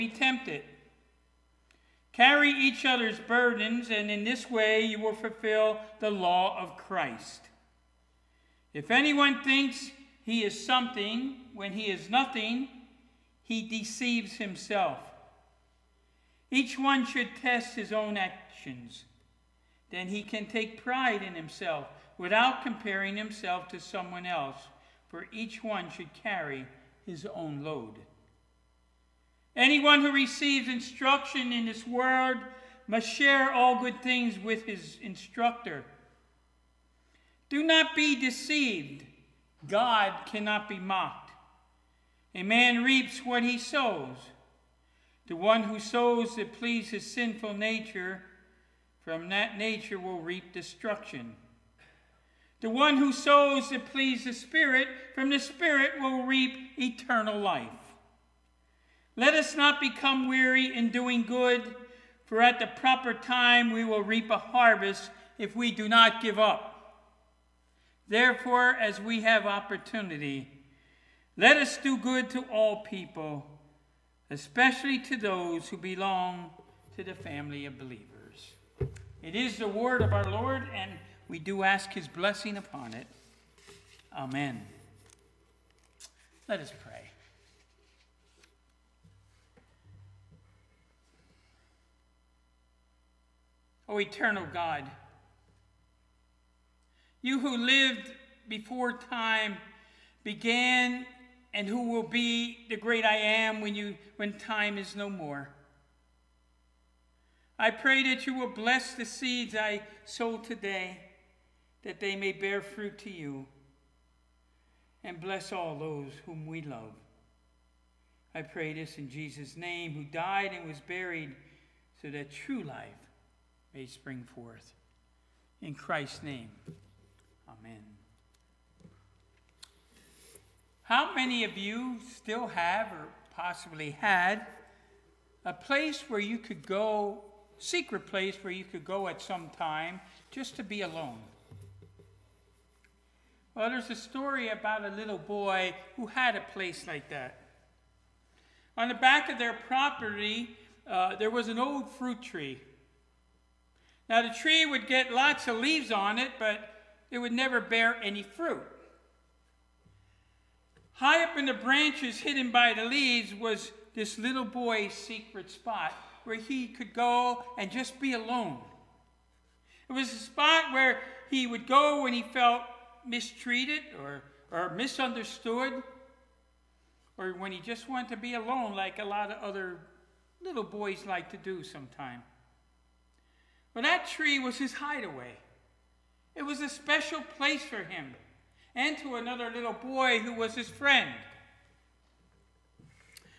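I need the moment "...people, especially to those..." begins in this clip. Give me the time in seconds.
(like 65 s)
72 s.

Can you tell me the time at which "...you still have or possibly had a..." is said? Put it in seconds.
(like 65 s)
131 s.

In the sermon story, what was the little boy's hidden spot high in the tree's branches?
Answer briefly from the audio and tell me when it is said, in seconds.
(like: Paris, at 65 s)
his hideaway, at 184 s.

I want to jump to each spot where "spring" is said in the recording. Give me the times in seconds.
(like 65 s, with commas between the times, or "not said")
123 s.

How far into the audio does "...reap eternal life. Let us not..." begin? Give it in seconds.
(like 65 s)
56 s.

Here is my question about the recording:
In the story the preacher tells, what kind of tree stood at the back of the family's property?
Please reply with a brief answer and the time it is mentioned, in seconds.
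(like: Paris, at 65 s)
fruit tree, at 151 s.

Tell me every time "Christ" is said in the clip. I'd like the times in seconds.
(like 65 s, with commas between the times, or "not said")
6 s, 125 s.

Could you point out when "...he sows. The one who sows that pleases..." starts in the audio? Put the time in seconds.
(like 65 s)
43 s.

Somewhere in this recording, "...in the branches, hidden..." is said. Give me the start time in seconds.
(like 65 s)
161 s.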